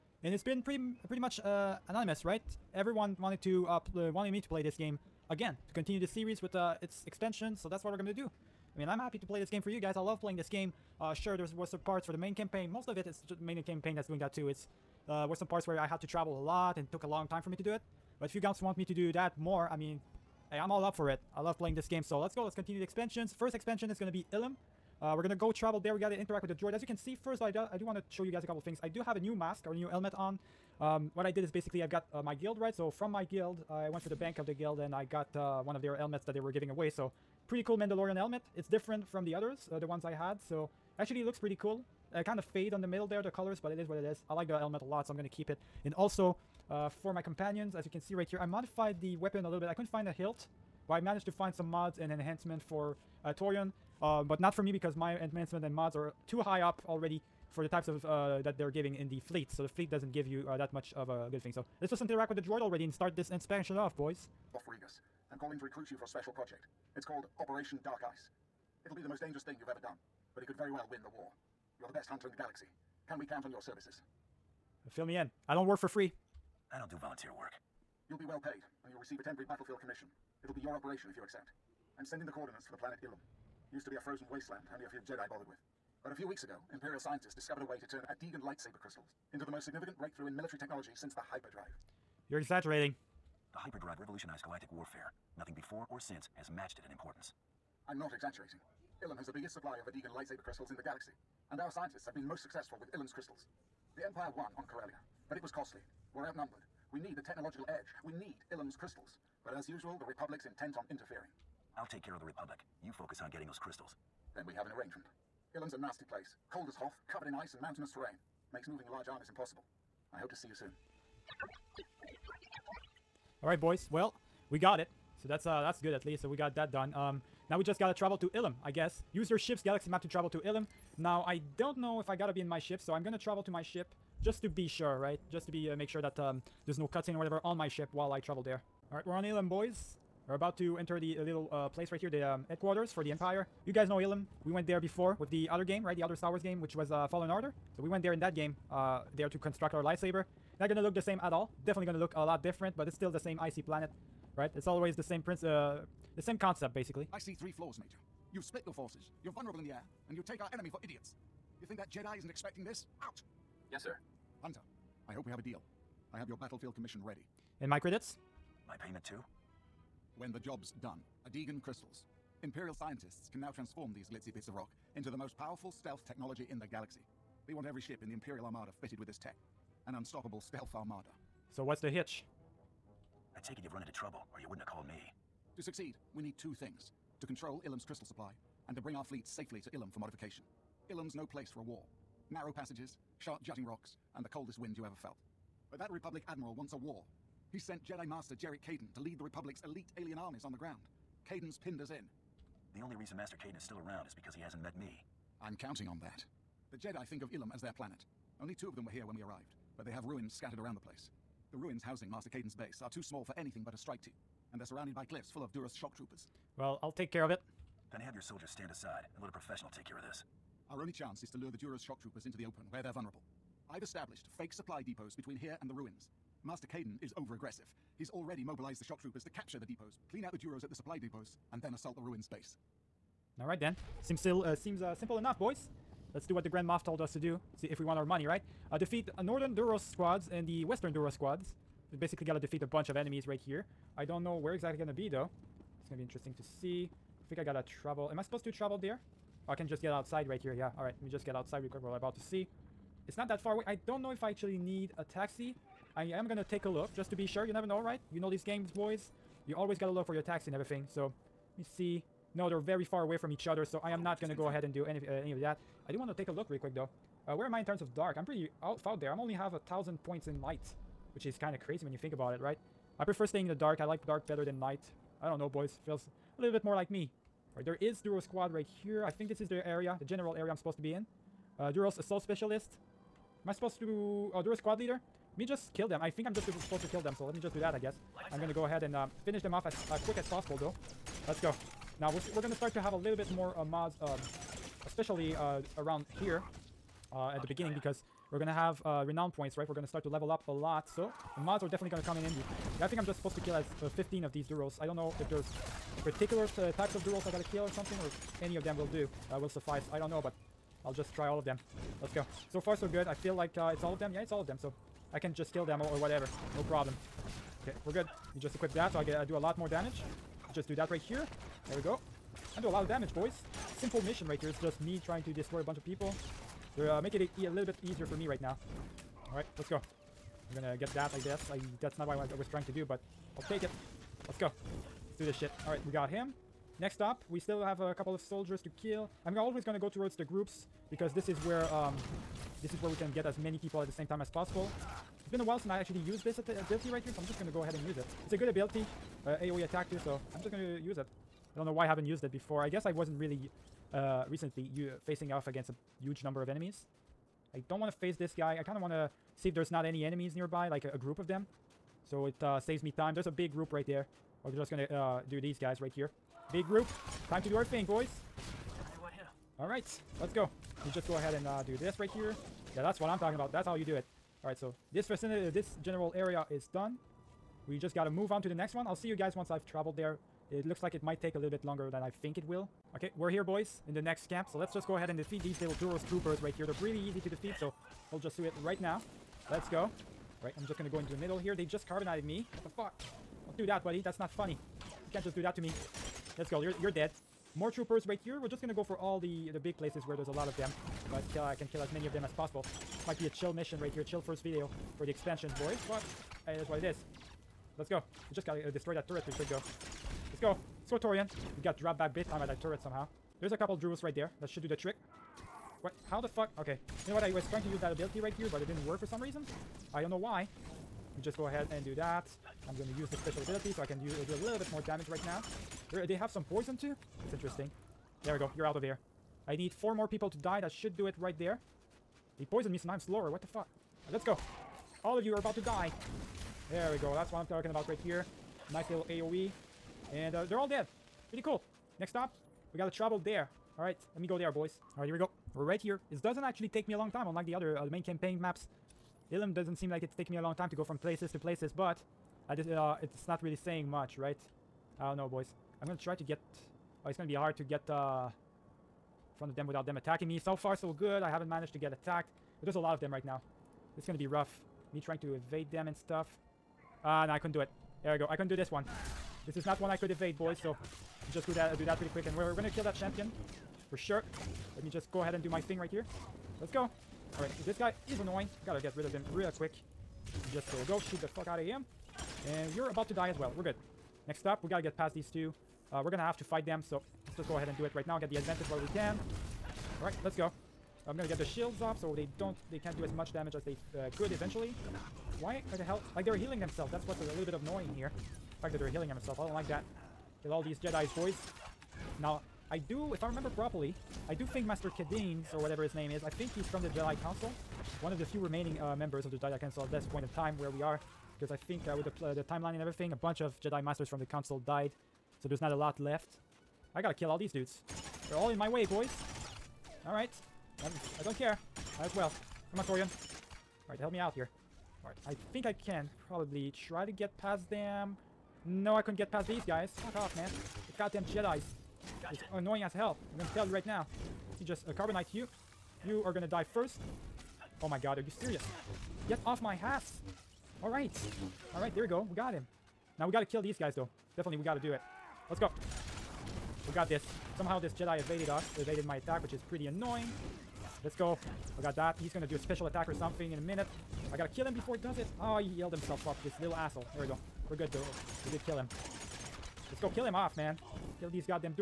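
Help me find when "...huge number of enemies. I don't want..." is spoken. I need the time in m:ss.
5:56.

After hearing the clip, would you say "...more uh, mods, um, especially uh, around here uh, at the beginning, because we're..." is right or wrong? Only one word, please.
right.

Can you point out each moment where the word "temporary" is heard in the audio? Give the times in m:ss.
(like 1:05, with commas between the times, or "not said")
1:19.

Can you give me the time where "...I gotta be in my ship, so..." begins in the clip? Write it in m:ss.
2:12.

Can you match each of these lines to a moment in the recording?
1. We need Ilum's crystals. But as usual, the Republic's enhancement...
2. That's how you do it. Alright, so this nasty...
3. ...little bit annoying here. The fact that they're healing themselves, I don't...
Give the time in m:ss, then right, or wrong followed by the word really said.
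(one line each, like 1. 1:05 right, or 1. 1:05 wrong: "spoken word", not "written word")
1. 1:48 wrong: "intent", not "enhancement"
2. 6:13 wrong: "vicinity", not "nasty"
3. 8:17 right.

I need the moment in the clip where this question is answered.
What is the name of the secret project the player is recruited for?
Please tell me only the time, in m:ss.
1:07.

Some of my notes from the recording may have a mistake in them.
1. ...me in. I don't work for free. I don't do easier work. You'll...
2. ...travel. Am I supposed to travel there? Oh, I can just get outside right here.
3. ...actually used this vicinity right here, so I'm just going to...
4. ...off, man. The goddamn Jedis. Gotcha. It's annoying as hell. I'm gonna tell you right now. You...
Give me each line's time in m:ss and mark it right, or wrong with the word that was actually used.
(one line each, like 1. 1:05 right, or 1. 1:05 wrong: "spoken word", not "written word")
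1. 1:15 wrong: "volunteer", not "easier"
2. 4:07 right
3. 5:45 wrong: "ability", not "vicinity"
4. 8:50 right.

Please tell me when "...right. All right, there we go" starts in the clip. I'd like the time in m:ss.
9:00.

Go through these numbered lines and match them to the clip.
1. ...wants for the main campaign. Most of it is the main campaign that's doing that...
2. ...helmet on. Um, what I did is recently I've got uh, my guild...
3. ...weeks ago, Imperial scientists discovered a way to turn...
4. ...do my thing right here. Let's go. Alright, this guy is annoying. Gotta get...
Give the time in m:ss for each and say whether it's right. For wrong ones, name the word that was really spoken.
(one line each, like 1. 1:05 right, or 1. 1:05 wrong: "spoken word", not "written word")
1. 0:11 wrong: "parts", not "wants"
2. 0:29 wrong: "basically", not "recently"
3. 1:26 right
4. 7:55 right.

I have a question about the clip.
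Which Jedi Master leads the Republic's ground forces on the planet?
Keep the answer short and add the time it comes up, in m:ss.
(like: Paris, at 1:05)
Jarek Caden, at 3:18.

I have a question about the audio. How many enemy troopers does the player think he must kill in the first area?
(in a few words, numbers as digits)
15.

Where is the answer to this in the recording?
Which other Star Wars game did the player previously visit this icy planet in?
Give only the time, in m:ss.
2:27.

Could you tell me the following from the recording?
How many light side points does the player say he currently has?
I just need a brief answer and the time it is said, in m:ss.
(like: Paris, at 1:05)
1000, at 4:29.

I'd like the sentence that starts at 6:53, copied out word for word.
There's a couple Druids right there.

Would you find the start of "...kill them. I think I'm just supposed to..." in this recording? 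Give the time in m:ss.
4:45.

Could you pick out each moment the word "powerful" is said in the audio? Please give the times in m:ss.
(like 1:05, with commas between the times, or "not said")
2:55.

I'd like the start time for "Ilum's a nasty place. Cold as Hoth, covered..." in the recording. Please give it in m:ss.
1:55.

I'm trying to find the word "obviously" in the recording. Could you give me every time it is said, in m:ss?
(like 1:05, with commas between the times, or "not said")
not said.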